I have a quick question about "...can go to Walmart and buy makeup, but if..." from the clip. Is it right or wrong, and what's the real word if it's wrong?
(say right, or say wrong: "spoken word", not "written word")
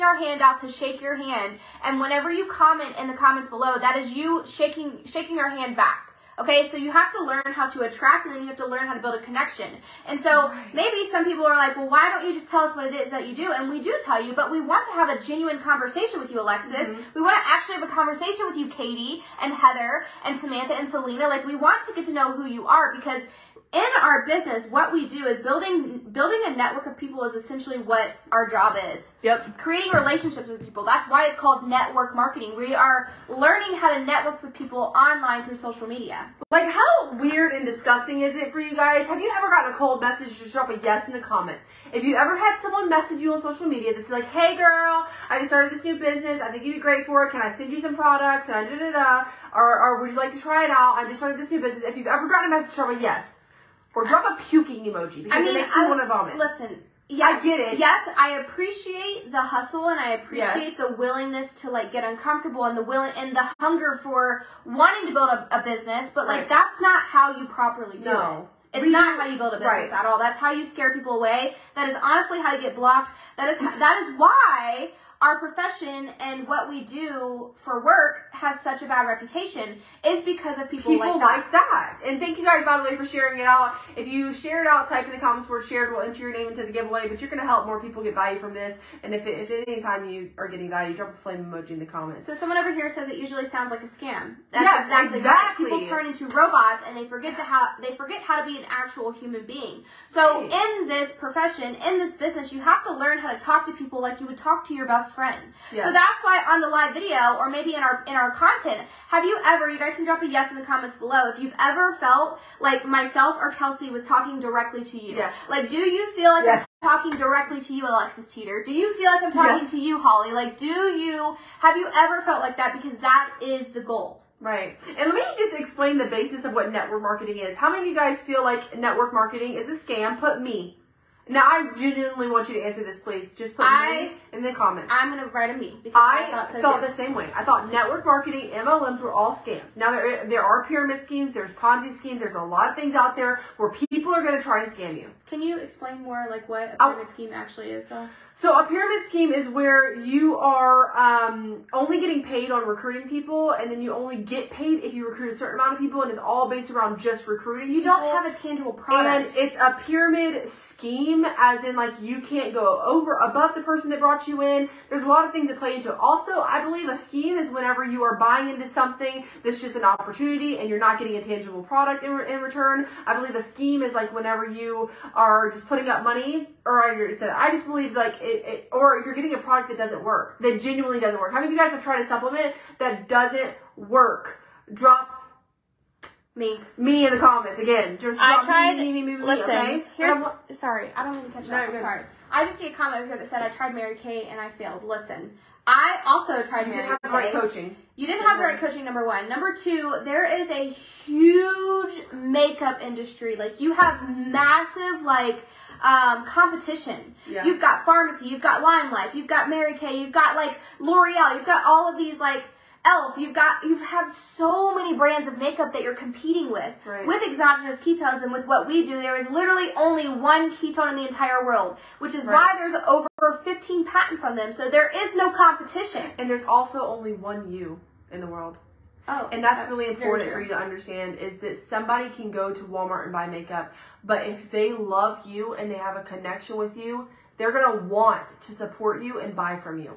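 right.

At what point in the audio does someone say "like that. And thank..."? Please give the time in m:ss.
1:21.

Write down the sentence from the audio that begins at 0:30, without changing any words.
That's why it's called network marketing.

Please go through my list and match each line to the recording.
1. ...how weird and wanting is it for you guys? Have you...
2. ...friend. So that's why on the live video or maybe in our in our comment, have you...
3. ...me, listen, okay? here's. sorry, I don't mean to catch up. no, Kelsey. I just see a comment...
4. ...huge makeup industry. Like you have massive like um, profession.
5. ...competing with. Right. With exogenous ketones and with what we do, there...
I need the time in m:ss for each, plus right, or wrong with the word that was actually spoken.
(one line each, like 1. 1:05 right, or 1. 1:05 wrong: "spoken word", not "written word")
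1. 0:36 wrong: "disgusting", not "wanting"
2. 1:45 wrong: "content", not "comment"
3. 3:09 wrong: "Sorry", not "Kelsey"
4. 3:20 wrong: "competition", not "profession"
5. 3:35 right.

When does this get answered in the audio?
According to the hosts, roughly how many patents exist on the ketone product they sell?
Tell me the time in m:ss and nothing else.
3:42.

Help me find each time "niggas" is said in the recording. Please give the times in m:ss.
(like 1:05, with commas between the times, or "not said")
not said.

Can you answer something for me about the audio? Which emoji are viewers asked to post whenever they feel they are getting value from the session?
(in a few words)
flame emoji.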